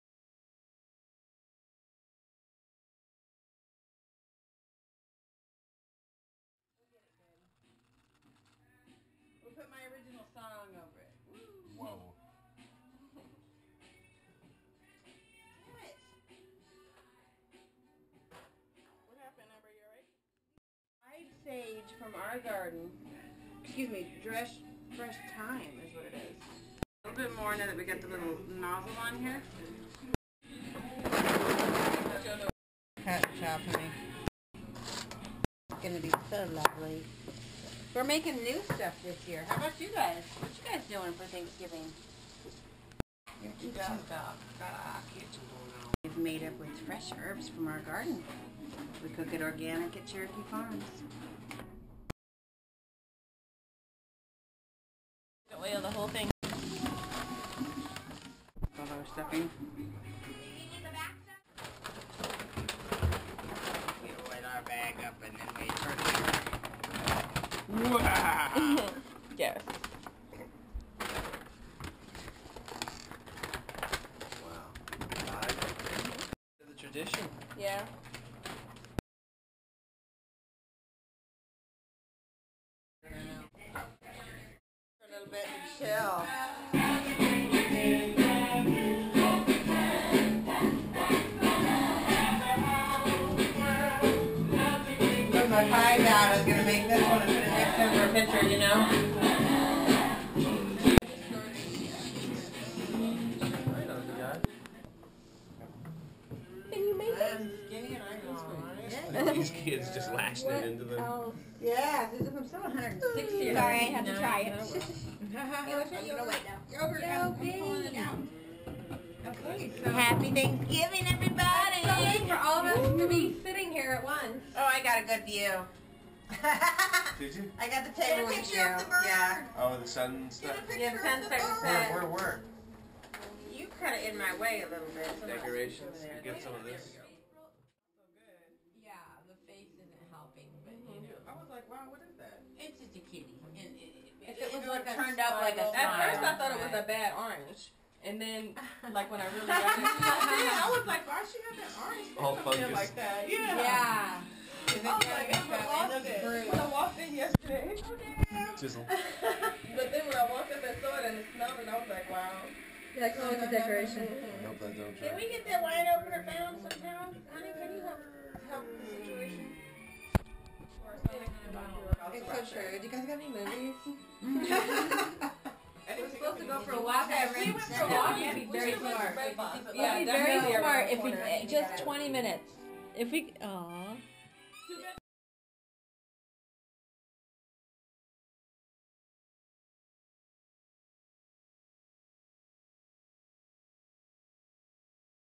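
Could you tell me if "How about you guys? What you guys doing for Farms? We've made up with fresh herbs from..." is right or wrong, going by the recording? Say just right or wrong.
wrong.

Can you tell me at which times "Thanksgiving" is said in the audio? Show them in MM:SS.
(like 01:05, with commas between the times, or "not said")
00:41, 02:00.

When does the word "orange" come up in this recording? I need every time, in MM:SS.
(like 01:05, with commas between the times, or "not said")
02:27, 02:31.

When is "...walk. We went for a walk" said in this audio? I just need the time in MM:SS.
02:56.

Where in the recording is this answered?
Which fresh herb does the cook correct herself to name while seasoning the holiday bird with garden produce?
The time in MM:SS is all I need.
00:24.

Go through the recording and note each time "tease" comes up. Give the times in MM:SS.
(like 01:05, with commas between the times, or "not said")
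not said.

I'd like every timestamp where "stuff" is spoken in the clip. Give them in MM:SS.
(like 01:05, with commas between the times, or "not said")
00:38, 02:10.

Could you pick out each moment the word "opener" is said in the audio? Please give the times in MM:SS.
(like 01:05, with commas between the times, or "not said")
02:45.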